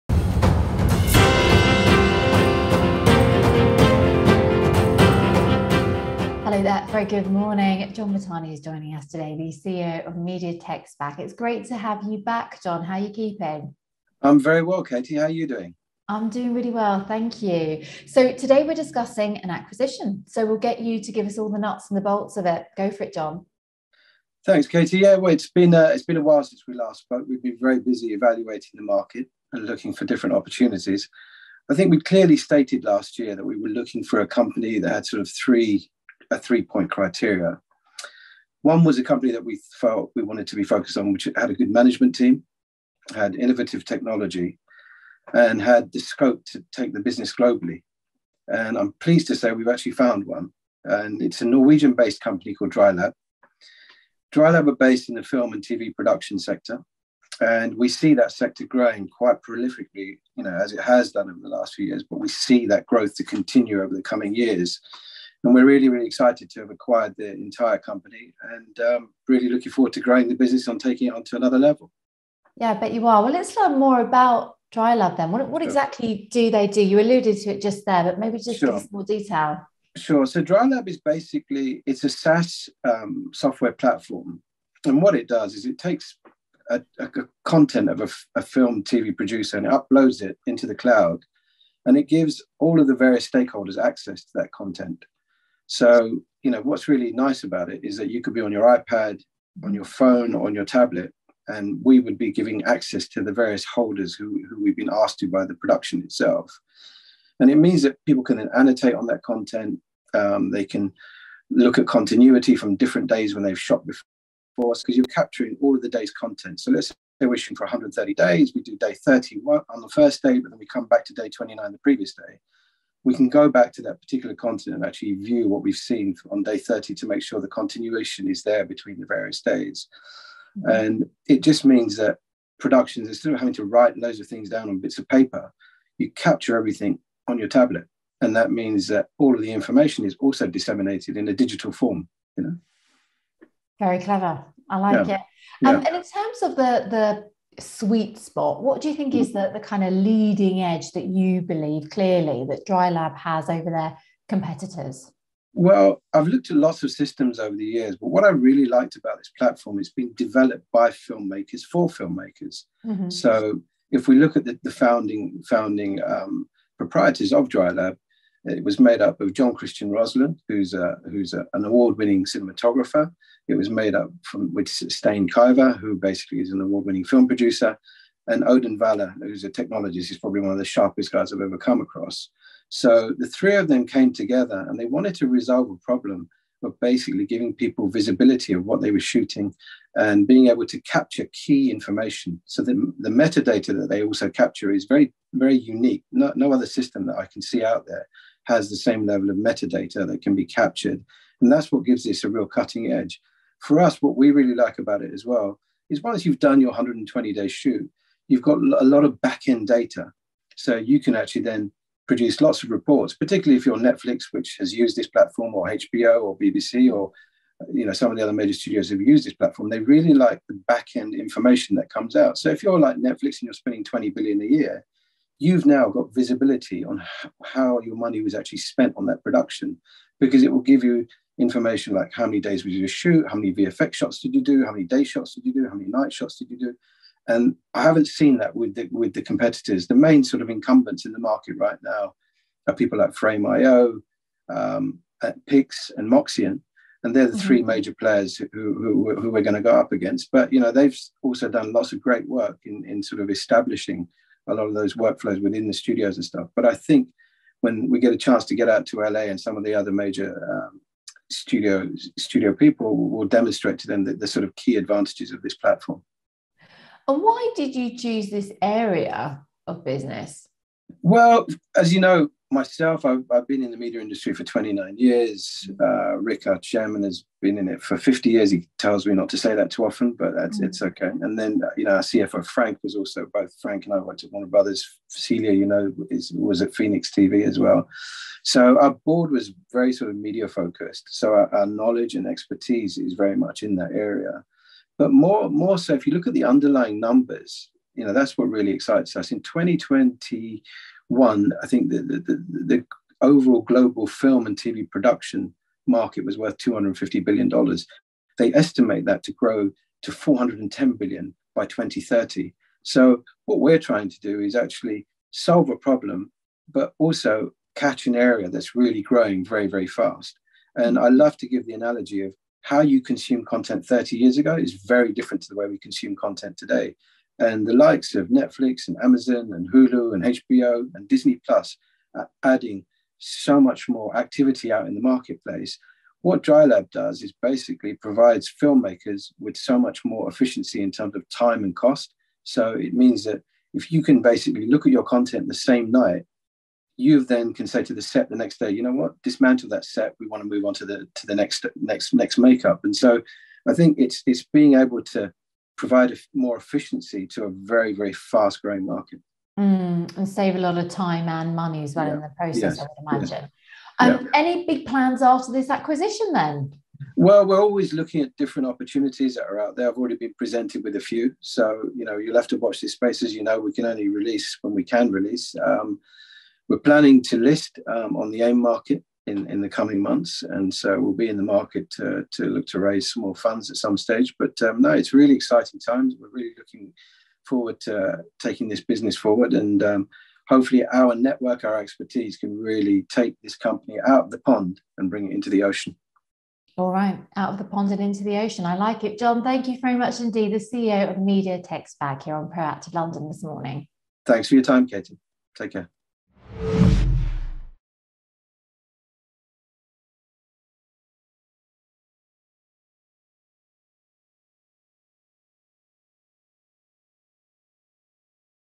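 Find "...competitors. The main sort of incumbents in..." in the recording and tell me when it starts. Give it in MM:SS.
03:59.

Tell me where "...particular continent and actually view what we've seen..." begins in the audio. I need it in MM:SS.
02:04.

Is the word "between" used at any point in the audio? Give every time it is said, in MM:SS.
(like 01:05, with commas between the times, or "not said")
02:08.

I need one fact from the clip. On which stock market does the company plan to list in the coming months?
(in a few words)
AIM.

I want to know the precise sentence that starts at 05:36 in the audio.
What Drylab does is basically provides filmmakers with so much more efficiency in terms of time and cost.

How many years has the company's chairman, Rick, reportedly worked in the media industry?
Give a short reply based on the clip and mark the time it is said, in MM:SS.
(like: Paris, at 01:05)
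50 years, at 04:37.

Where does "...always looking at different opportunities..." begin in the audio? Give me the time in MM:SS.
06:07.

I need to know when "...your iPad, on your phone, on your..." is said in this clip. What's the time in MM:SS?
01:38.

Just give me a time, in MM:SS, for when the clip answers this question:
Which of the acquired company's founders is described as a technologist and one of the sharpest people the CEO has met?
02:58.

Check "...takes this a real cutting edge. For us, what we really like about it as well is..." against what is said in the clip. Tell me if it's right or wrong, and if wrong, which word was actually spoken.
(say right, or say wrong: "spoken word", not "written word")
wrong: "gives", not "takes".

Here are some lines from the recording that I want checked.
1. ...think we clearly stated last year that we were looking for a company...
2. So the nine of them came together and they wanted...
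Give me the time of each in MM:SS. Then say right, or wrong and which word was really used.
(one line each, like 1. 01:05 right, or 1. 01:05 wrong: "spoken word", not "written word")
1. 00:31 right
2. 03:02 wrong: "three", not "nine".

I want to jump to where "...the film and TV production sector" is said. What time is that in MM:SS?
00:55.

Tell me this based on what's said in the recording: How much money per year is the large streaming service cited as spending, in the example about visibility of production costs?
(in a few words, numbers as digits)
20 billion.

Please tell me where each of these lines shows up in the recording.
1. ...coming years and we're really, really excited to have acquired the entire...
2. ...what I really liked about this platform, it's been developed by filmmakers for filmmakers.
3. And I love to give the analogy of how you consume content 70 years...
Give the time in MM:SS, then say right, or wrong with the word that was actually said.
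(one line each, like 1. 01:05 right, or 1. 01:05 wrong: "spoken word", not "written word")
1. 01:04 right
2. 02:38 right
3. 05:20 wrong: "30", not "70".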